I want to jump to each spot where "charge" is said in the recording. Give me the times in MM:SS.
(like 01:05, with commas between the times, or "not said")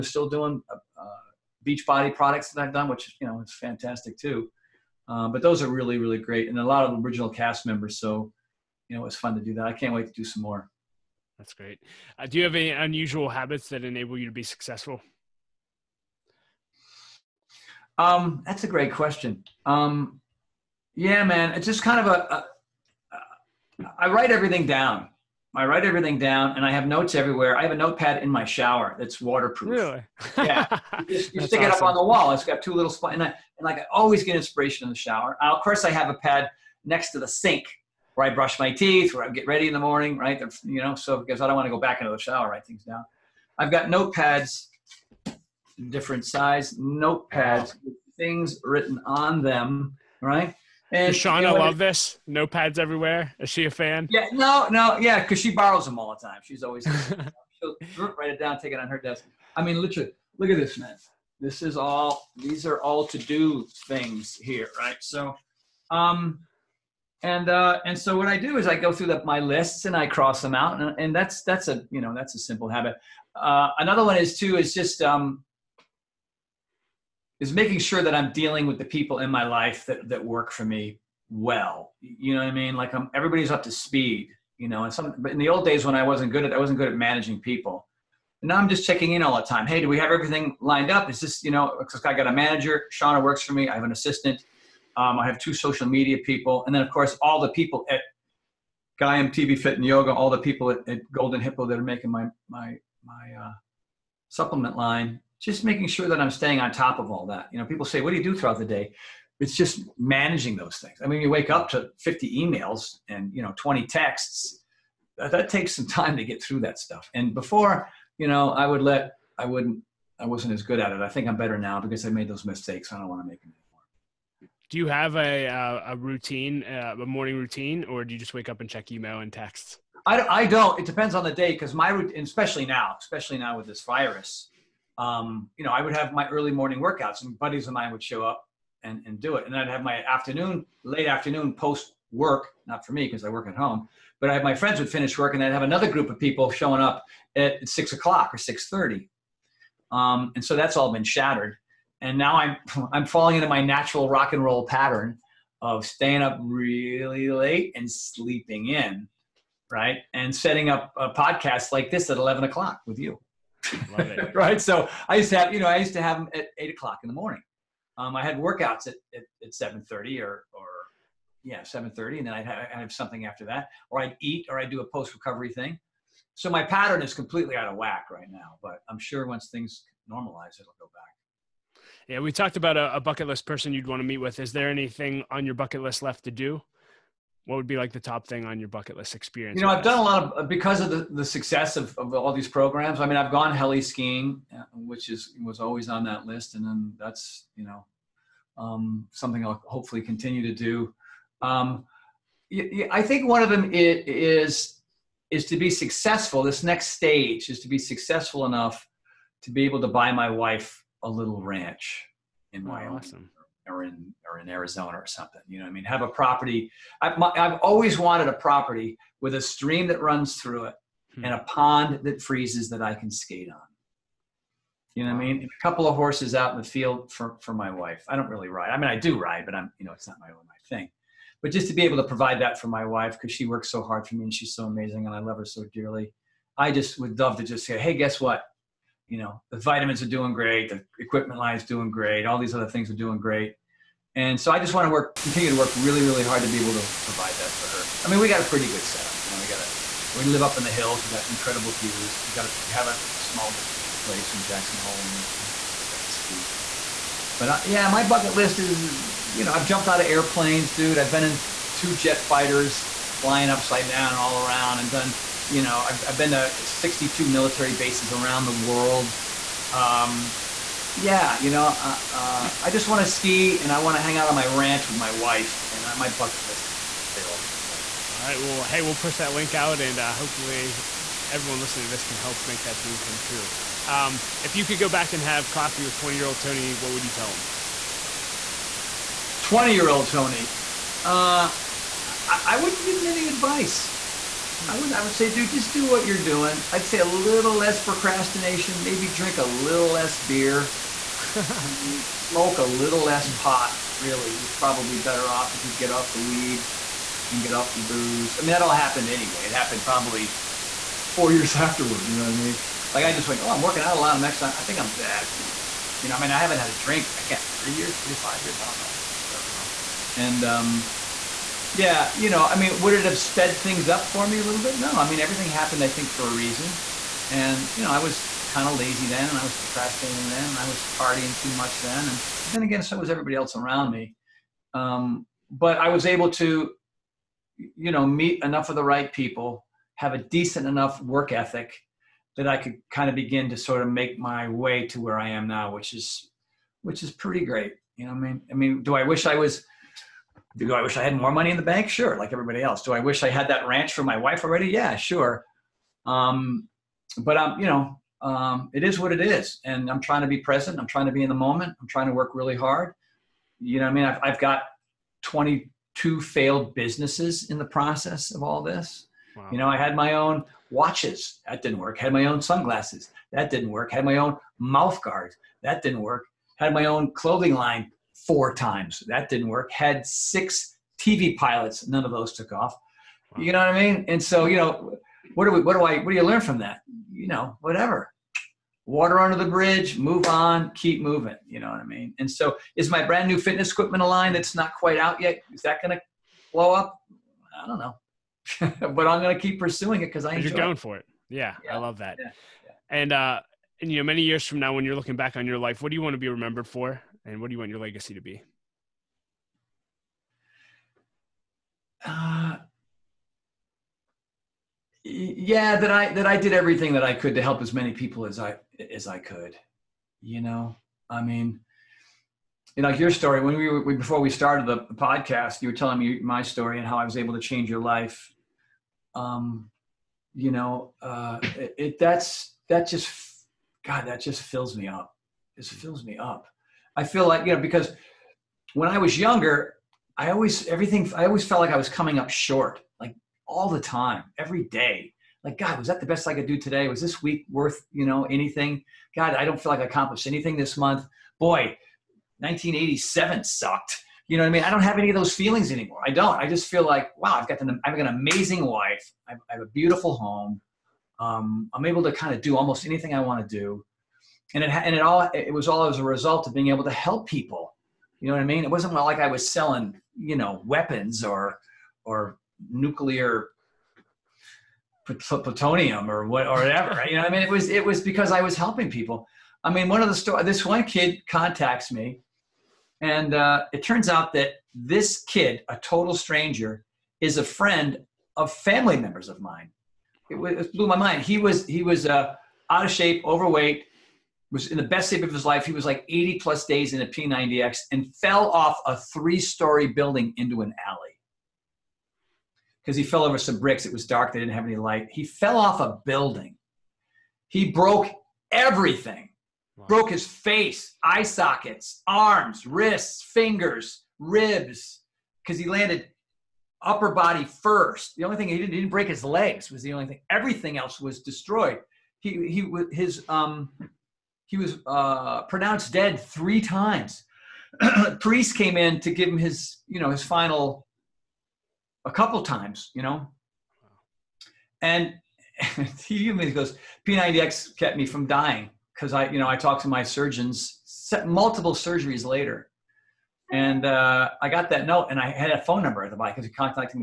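not said.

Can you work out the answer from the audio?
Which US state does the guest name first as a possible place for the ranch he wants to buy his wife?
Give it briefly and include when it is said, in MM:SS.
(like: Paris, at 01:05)
Wyoming, at 03:32.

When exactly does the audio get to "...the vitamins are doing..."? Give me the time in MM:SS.
03:59.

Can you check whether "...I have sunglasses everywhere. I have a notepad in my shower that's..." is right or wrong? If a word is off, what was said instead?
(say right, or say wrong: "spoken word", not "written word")
wrong: "notes", not "sunglasses".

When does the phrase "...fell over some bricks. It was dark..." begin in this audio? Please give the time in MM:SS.
08:23.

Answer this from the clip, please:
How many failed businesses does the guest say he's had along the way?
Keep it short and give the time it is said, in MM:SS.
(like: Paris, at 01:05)
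22, at 06:05.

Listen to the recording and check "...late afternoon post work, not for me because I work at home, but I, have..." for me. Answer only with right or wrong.
right.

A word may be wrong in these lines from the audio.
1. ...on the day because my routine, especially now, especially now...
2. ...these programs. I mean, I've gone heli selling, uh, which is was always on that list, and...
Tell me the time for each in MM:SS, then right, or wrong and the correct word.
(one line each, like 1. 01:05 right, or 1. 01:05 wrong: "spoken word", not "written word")
1. 02:11 right
2. 03:12 wrong: "skiing", not "selling".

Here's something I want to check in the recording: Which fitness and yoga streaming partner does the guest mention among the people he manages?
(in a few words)
Gaiam TV.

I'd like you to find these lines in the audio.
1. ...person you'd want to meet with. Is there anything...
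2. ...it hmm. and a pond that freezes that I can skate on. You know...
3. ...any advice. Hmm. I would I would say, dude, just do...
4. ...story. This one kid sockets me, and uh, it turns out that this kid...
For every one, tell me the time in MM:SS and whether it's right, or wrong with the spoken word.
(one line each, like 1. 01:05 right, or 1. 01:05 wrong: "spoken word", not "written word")
1. 03:03 right
2. 03:40 right
3. 04:53 right
4. 08:00 wrong: "contacts", not "sockets".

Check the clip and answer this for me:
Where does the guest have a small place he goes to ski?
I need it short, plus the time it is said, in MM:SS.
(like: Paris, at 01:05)
Jackson Hole, at 04:14.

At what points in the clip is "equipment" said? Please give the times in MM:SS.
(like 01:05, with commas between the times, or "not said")
04:00, 06:33.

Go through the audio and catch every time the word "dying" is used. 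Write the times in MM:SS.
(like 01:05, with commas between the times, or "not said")
08:58.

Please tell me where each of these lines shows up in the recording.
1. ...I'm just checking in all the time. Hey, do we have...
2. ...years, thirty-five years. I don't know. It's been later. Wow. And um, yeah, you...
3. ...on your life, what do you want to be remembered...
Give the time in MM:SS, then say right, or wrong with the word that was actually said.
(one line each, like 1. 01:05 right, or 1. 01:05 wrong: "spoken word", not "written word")
1. 01:28 right
2. 05:17 wrong: "forever", not "later"
3. 06:45 right.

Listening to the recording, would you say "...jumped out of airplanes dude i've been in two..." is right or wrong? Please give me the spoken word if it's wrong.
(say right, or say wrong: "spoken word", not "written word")
right.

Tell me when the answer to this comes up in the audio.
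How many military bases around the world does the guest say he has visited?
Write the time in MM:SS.
04:26.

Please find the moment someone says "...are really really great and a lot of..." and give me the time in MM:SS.
00:05.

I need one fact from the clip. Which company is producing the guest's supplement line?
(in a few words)
Golden Hippo.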